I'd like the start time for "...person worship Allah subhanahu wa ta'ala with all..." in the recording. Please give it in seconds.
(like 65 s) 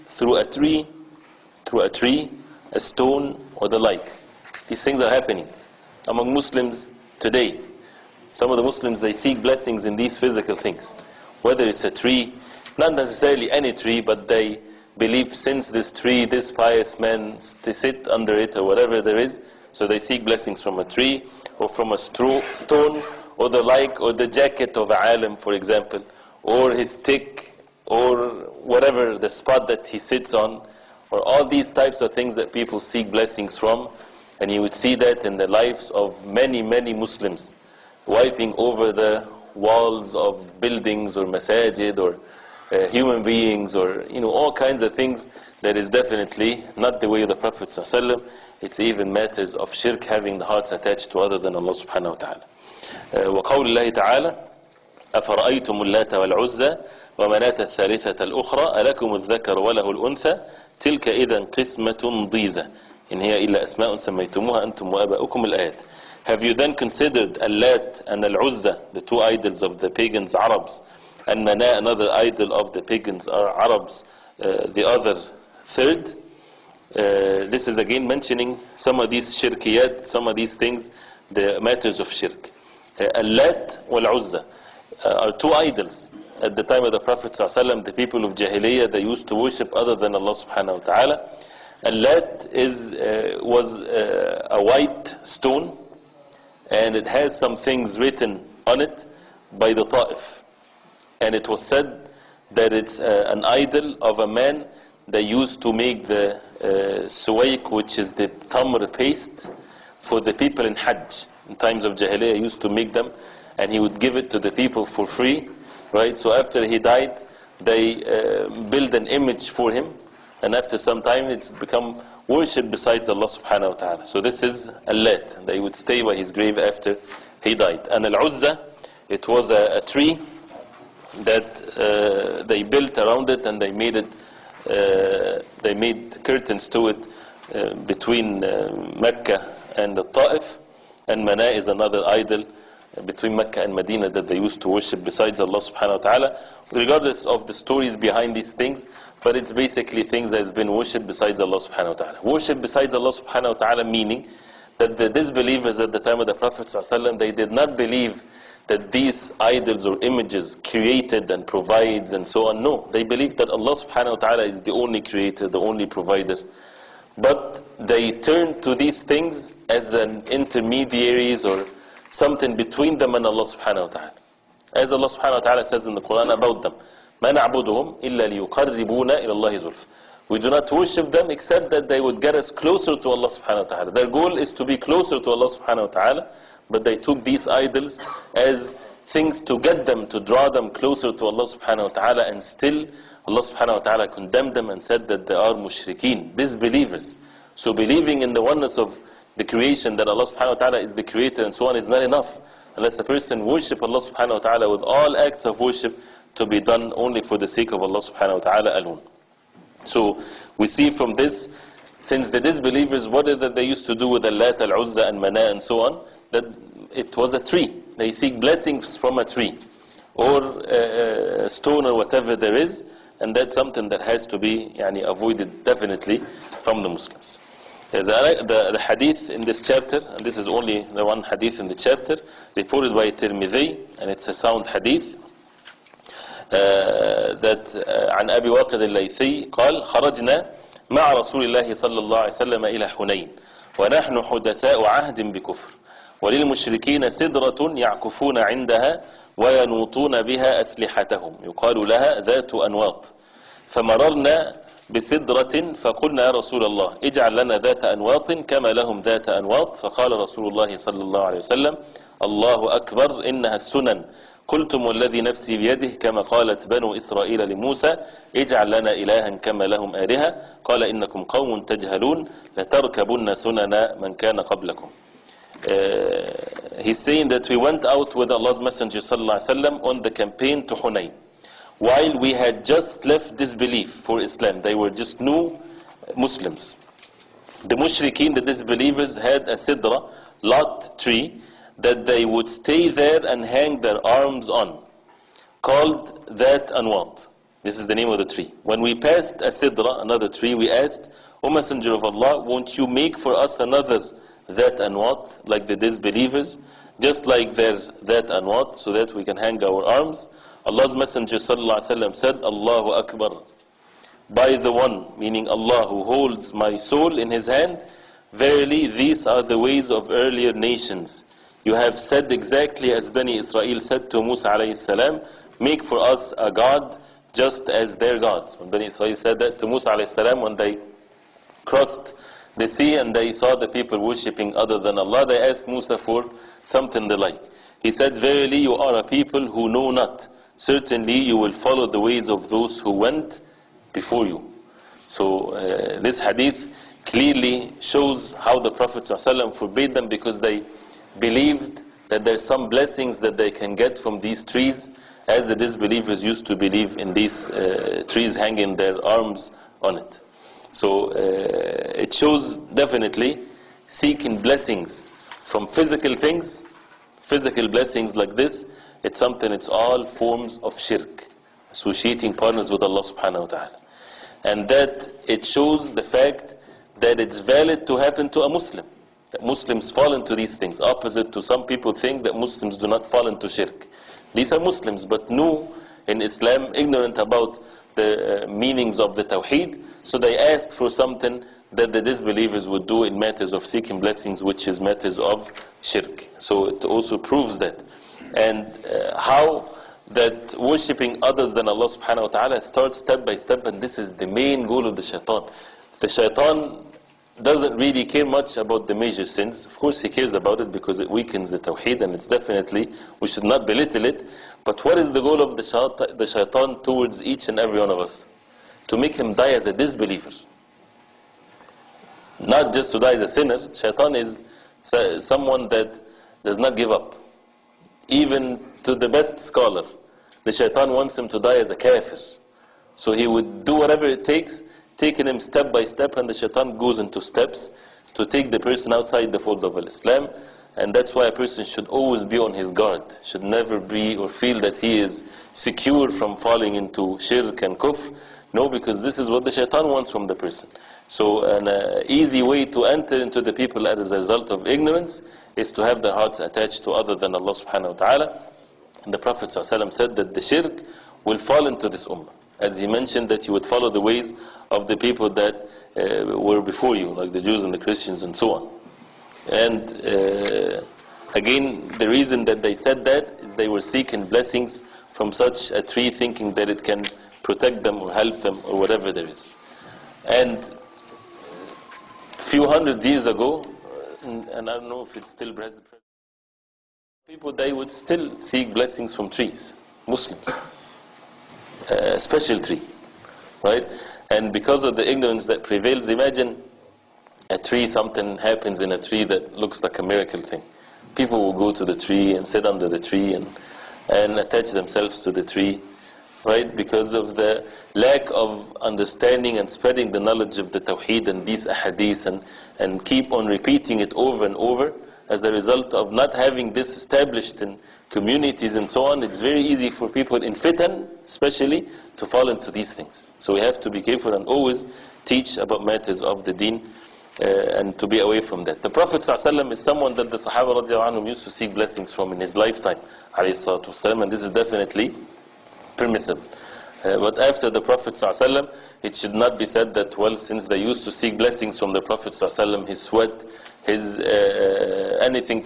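203 s.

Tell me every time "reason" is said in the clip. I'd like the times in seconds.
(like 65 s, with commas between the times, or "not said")
472 s.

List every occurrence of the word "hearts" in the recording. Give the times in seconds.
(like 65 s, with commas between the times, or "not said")
50 s, 456 s.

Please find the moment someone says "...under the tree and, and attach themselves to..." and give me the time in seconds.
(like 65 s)
502 s.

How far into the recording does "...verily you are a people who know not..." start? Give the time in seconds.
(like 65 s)
338 s.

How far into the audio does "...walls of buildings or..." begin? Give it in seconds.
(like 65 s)
39 s.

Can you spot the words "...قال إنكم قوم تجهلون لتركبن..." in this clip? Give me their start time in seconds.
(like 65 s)
270 s.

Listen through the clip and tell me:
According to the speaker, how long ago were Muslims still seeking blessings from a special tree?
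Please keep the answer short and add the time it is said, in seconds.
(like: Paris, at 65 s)
A few hundred years, at 482 s.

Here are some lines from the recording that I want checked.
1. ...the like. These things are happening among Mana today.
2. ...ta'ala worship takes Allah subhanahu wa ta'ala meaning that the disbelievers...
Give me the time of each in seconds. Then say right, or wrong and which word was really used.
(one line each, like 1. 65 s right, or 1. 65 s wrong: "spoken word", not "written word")
1. 3 s wrong: "Muslims", not "Mana"
2. 151 s wrong: "besides", not "takes".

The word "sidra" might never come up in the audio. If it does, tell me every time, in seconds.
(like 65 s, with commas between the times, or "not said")
289 s, 299 s.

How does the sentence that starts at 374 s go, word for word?
And that it shows the fact that it's valid to happen to a Muslim.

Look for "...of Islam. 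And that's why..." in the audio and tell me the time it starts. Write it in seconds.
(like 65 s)
439 s.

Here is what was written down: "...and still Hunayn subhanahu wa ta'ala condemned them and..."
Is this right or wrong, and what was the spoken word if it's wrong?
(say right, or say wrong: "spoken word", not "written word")
wrong: "Allah", not "Hunayn".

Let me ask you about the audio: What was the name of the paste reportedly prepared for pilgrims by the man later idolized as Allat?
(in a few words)
Suwaik.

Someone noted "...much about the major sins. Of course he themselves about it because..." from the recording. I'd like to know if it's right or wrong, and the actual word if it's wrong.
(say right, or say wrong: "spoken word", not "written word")
wrong: "cares", not "themselves".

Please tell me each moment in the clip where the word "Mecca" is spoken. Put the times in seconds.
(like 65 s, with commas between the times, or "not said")
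138 s, 143 s.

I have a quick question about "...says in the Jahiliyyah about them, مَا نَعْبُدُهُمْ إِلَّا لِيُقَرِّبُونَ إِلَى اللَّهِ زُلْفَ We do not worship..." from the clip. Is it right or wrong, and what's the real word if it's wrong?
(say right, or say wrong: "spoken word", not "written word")
wrong: "Quran", not "Jahiliyyah".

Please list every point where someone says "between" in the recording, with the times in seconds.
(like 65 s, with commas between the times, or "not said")
137 s, 143 s, 172 s.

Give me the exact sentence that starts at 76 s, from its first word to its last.
Uh, this is again mentioning some of these shirkiyat, some of these things, the matters of shirk.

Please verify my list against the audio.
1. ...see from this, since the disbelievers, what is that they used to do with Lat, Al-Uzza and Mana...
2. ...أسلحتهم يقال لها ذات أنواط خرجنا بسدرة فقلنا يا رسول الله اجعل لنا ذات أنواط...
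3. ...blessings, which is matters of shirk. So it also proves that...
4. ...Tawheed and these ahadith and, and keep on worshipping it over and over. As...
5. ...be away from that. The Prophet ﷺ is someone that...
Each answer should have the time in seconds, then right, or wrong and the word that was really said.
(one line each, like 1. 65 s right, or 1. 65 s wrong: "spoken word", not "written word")
1. 210 s right
2. 250 s wrong: "فمررنا", not "خرجنا"
3. 393 s right
4. 510 s wrong: "repeating", not "worshipping"
5. 528 s right.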